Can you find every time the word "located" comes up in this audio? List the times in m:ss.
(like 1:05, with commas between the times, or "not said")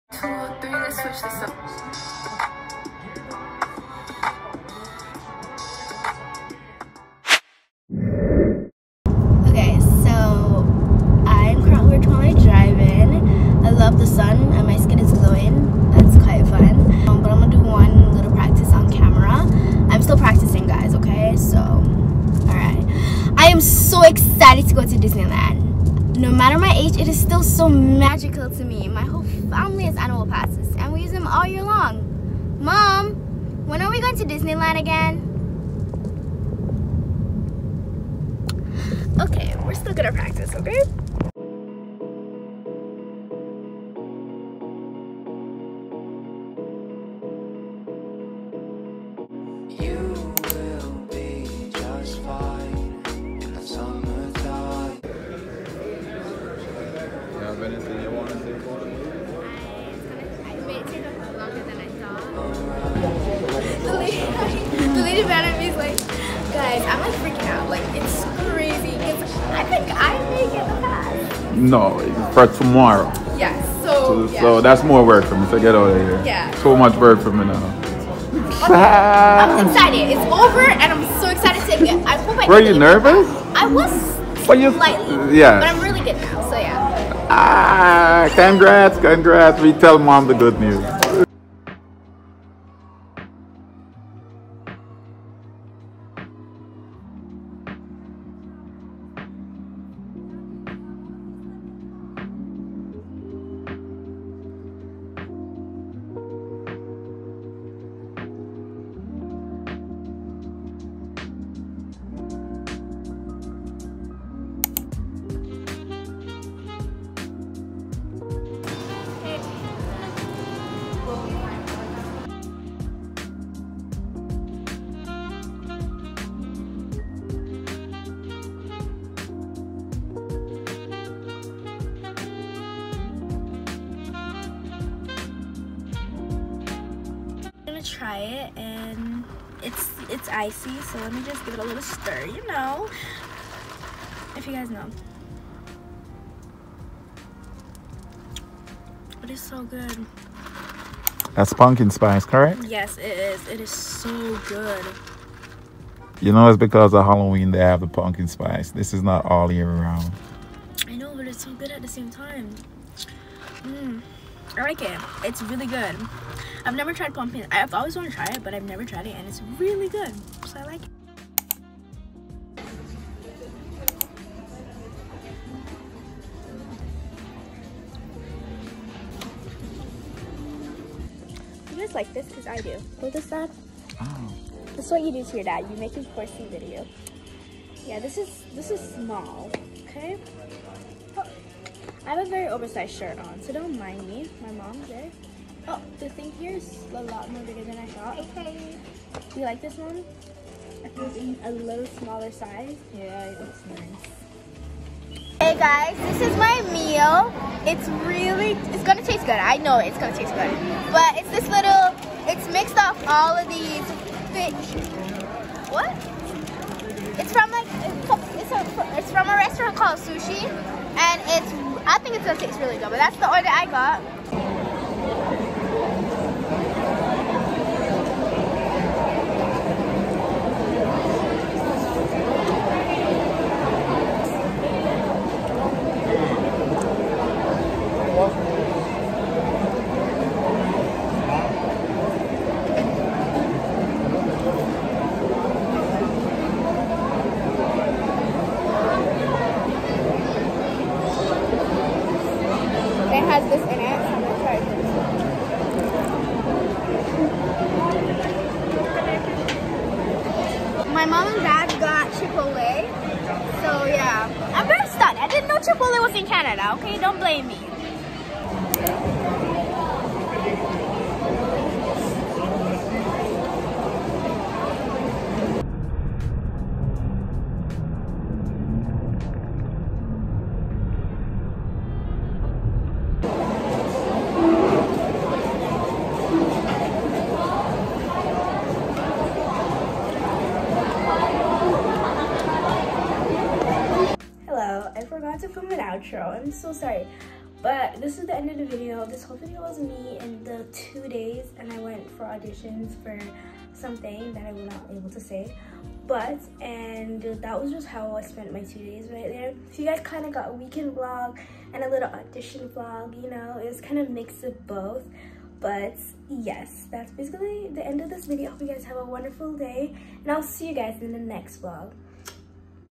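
not said.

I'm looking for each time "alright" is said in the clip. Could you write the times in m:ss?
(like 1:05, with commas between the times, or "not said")
0:21.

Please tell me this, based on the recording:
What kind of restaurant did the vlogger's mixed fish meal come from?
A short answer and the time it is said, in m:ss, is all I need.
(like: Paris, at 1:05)
Sushi, at 3:39.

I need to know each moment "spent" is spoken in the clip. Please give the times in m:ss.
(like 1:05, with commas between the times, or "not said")
5:08.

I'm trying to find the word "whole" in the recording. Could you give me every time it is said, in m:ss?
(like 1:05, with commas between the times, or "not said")
0:29, 4:59.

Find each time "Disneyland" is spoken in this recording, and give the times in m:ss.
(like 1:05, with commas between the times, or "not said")
0:24, 0:34.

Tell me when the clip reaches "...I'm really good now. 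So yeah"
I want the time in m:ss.
1:25.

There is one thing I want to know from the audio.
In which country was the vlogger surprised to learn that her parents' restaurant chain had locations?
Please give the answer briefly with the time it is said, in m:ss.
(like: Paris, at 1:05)
Canada, at 4:26.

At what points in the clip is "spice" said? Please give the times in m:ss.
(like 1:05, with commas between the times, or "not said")
2:31, 2:38.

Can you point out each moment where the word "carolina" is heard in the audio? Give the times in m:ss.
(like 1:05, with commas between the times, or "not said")
not said.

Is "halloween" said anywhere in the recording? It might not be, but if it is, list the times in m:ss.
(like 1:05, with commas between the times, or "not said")
2:37.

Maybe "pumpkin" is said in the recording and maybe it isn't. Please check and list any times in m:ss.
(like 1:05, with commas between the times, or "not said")
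2:31, 2:37, 2:47.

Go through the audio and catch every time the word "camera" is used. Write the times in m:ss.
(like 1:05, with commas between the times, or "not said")
0:18.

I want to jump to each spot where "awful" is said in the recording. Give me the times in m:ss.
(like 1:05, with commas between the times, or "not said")
not said.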